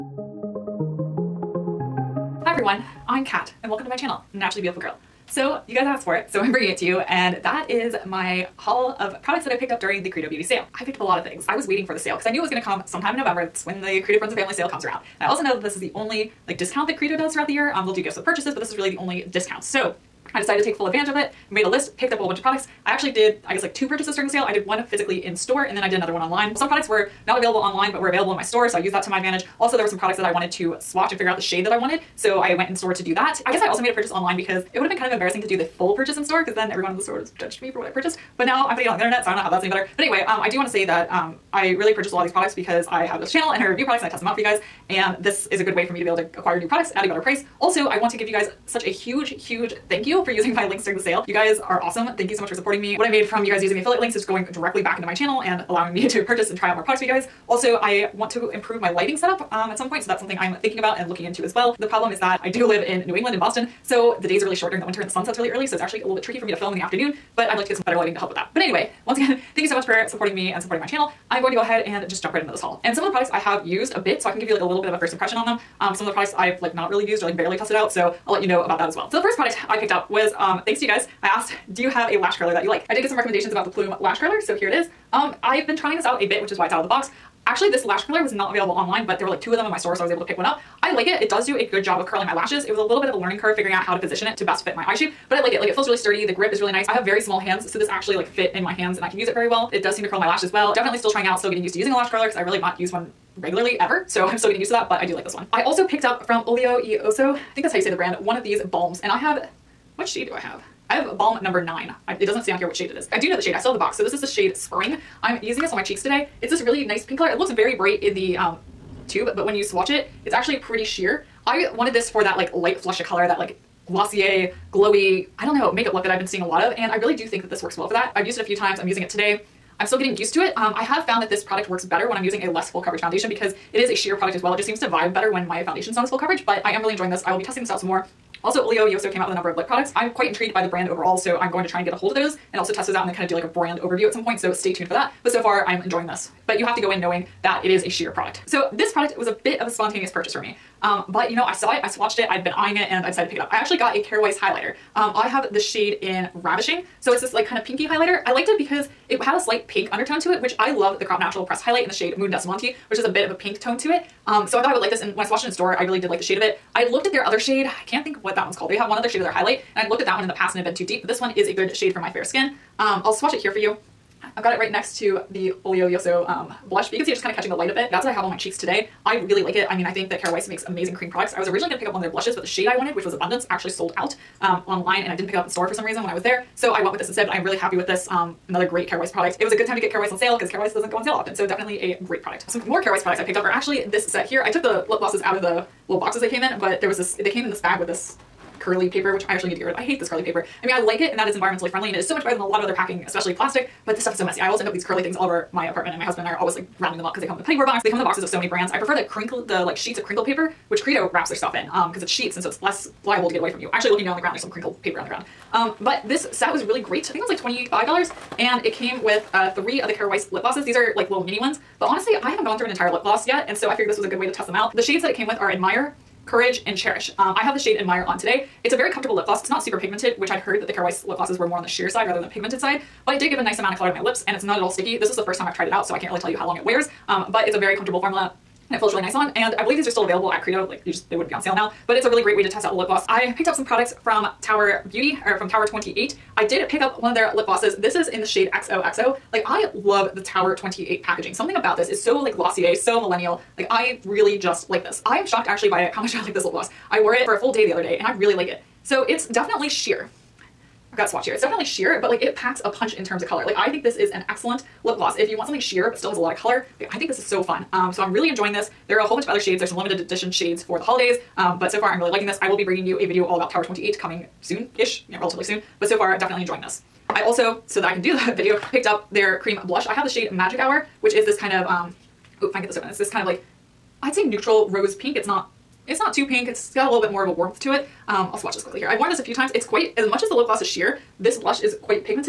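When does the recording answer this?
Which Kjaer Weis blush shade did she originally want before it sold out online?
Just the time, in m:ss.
3:03.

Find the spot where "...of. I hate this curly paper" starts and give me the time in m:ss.
3:19.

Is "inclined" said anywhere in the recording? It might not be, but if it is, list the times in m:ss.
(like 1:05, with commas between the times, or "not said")
not said.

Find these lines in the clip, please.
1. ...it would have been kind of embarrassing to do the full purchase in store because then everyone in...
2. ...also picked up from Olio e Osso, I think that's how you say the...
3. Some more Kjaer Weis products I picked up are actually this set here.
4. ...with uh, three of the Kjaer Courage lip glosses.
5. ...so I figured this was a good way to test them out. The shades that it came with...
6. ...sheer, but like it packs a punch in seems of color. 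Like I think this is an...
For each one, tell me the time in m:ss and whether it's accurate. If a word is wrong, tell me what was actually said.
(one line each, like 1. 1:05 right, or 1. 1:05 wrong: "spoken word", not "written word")
1. 0:34 right
2. 1:45 right
3. 3:12 right
4. 3:39 wrong: "Weis", not "Courage"
5. 3:43 right
6. 4:21 wrong: "terms", not "seems".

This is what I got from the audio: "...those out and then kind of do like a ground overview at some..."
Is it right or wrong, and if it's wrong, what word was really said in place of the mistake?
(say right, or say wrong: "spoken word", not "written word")
wrong: "brand", not "ground".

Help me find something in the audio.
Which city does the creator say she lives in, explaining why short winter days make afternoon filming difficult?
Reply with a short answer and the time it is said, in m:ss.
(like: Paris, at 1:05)
Boston, at 1:03.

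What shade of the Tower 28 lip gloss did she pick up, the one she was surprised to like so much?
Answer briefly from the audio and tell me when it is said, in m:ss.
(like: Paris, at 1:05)
XOXO, at 4:08.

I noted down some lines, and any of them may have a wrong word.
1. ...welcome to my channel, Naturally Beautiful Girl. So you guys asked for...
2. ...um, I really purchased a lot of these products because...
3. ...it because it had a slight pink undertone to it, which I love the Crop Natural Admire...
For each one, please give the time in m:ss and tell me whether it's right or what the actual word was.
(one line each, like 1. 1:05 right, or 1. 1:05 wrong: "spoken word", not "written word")
1. 0:03 right
2. 0:41 right
3. 2:38 wrong: "Press", not "Admire".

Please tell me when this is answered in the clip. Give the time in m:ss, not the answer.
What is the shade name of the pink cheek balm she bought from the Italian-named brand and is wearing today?
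1:54.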